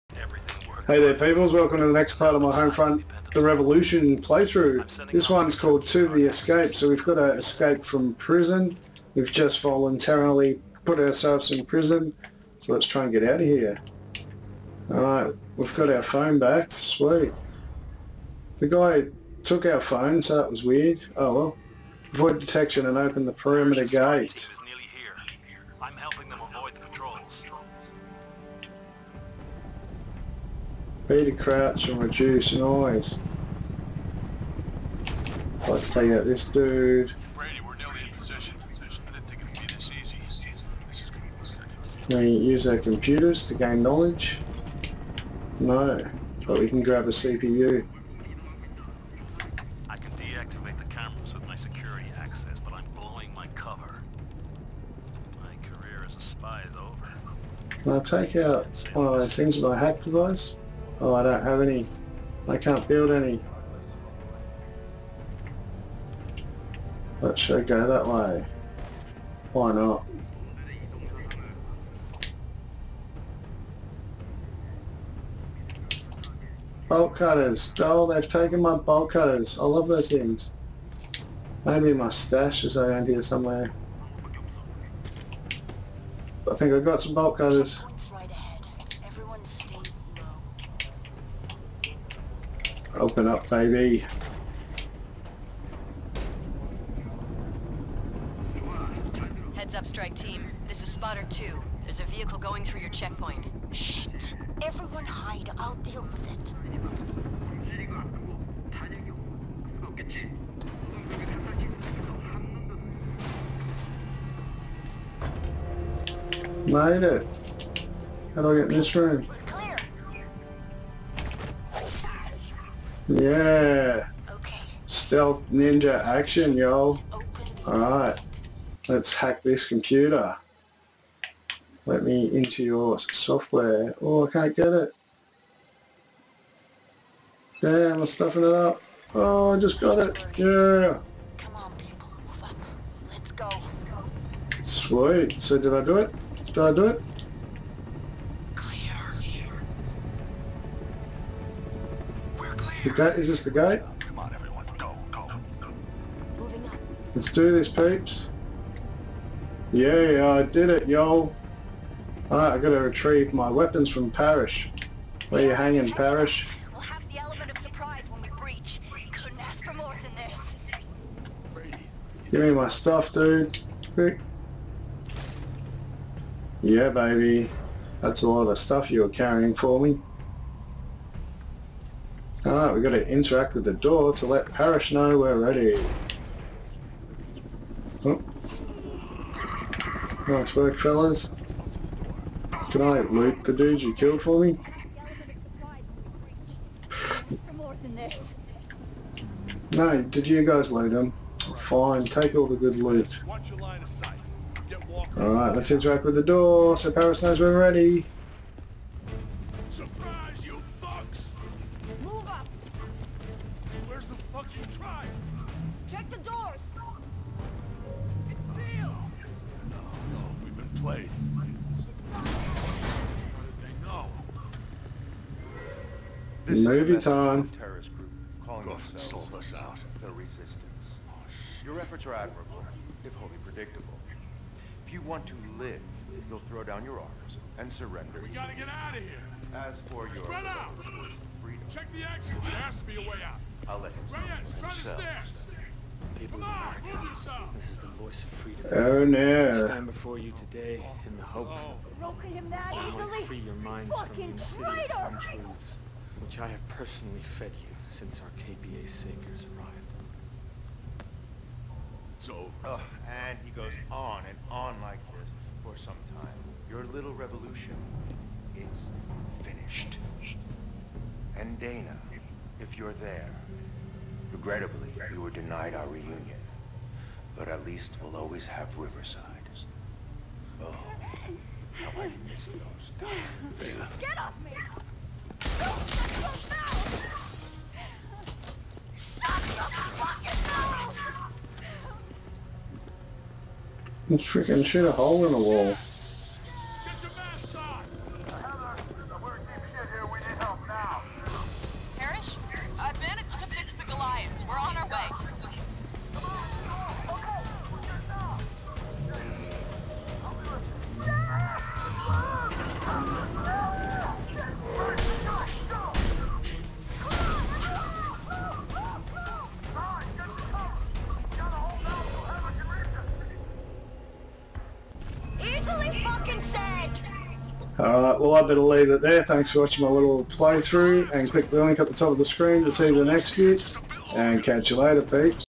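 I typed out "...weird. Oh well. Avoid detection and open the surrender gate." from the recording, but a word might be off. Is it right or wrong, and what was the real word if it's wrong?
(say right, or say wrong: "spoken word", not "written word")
wrong: "perimeter", not "surrender".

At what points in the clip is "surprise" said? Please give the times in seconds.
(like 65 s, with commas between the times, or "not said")
167 s, 209 s.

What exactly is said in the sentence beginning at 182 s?
Alright, we we've gotta interact with the door to let Parrish know we're ready.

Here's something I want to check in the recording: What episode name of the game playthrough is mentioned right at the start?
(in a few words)
To The Rescue.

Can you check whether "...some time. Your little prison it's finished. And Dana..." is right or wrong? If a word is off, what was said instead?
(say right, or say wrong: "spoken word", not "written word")
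wrong: "revolution", not "prison".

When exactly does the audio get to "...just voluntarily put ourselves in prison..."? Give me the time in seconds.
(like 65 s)
9 s.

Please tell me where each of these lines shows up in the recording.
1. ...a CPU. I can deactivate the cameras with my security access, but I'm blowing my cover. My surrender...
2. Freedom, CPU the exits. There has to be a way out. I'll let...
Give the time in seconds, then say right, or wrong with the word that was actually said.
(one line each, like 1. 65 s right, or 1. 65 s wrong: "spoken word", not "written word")
1. 47 s wrong: "career", not "surrender"
2. 241 s wrong: "Check", not "CPU".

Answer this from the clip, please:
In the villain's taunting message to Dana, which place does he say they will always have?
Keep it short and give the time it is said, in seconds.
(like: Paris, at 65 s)
Riverside, at 278 s.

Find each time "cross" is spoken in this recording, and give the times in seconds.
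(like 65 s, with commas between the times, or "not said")
not said.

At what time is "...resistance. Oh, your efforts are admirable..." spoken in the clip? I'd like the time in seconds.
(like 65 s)
230 s.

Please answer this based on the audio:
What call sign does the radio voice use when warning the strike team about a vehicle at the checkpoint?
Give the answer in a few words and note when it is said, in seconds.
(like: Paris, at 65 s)
Spotter 2, at 100 s.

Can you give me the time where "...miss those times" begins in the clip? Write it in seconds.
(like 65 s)
282 s.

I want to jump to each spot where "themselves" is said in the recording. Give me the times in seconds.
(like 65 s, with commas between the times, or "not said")
228 s.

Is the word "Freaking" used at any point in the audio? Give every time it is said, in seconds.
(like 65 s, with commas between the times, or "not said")
294 s.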